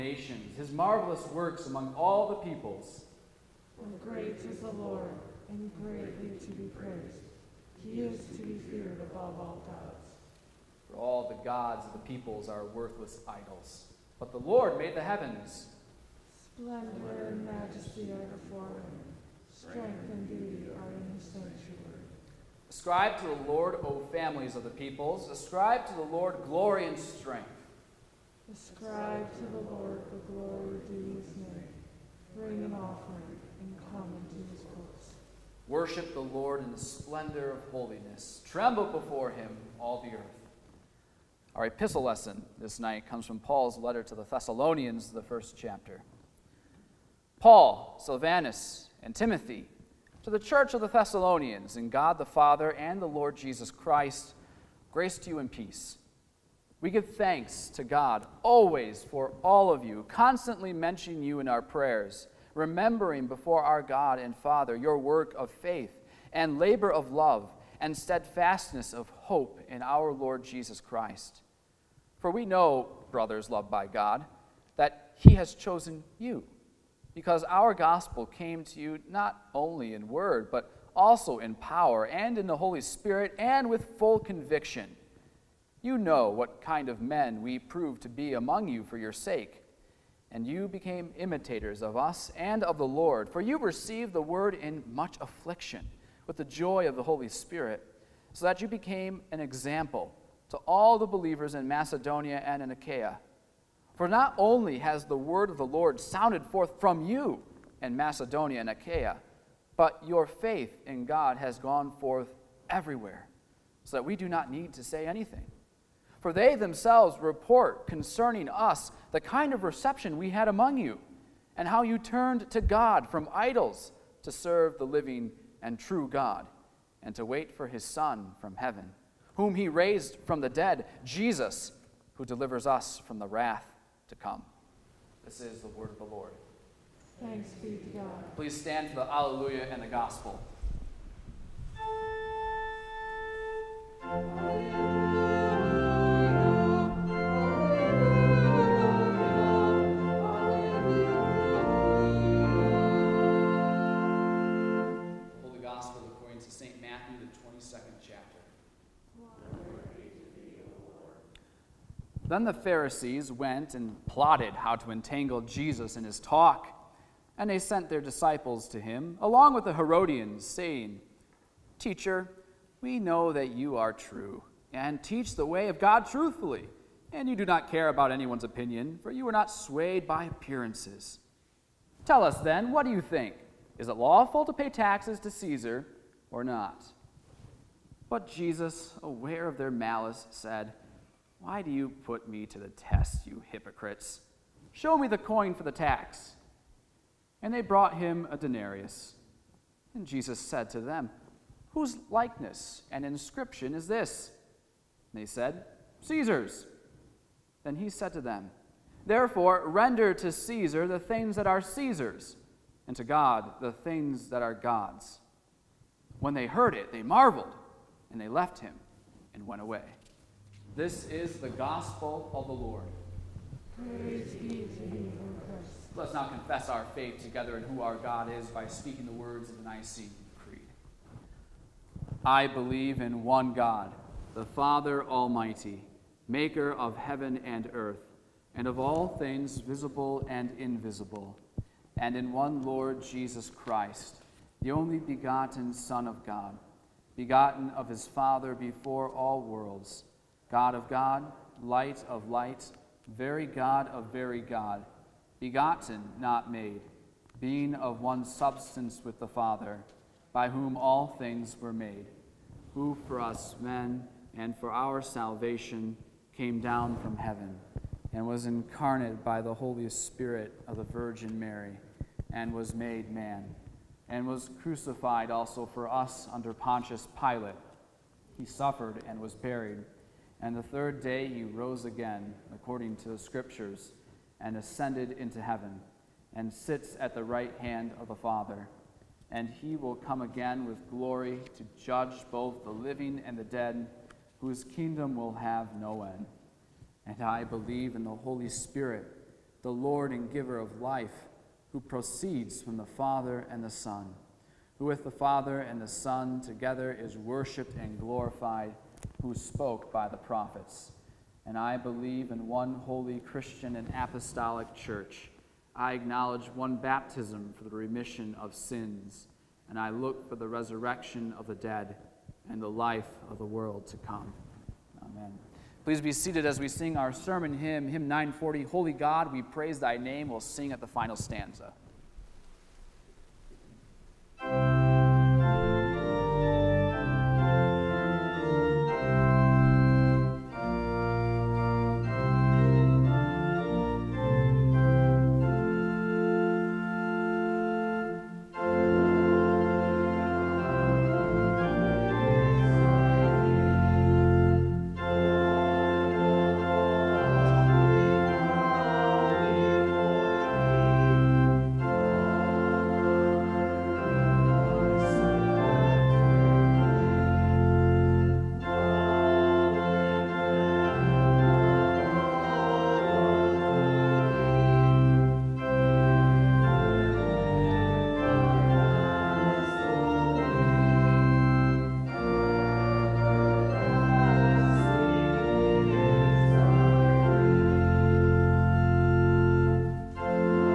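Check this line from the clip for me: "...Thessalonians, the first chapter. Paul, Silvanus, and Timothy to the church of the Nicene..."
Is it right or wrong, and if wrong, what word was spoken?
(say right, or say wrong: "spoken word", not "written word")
wrong: "Thessalonians", not "Nicene".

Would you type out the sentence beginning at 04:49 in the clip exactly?
And he will come again with glory to judge both the living and the dead, whose kingdom will have no end.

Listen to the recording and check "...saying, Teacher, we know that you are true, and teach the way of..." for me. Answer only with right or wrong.
right.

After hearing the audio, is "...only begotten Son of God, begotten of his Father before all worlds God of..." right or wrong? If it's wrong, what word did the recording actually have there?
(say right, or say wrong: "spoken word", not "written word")
right.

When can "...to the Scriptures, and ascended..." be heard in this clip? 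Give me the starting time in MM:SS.
04:42.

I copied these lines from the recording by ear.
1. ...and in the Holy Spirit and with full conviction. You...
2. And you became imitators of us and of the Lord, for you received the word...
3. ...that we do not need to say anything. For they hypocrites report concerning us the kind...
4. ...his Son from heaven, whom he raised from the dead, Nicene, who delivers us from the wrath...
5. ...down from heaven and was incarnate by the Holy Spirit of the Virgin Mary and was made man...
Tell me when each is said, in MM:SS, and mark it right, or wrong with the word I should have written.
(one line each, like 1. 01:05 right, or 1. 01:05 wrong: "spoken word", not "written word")
1. 01:22 right
2. 01:30 right
3. 01:53 wrong: "themselves", not "hypocrites"
4. 02:07 wrong: "Jesus", not "Nicene"
5. 04:26 right.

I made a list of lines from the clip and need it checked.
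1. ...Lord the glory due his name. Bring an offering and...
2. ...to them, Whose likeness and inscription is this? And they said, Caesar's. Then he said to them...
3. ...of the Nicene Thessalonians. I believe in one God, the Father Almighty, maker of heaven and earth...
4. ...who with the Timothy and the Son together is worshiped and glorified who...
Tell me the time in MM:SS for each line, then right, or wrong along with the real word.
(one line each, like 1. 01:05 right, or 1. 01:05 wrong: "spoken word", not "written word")
1. 00:29 right
2. 03:20 right
3. 03:49 wrong: "Creed", not "Thessalonians"
4. 05:04 wrong: "Father", not "Timothy".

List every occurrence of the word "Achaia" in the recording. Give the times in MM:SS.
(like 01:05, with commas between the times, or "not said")
01:42, 01:48.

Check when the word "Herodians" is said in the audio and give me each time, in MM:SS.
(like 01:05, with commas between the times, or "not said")
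02:49.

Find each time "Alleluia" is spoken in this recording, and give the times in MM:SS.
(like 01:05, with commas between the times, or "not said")
02:19, 02:24.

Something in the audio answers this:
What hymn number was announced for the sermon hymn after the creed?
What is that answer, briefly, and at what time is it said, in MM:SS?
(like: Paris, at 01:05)
940, at 05:28.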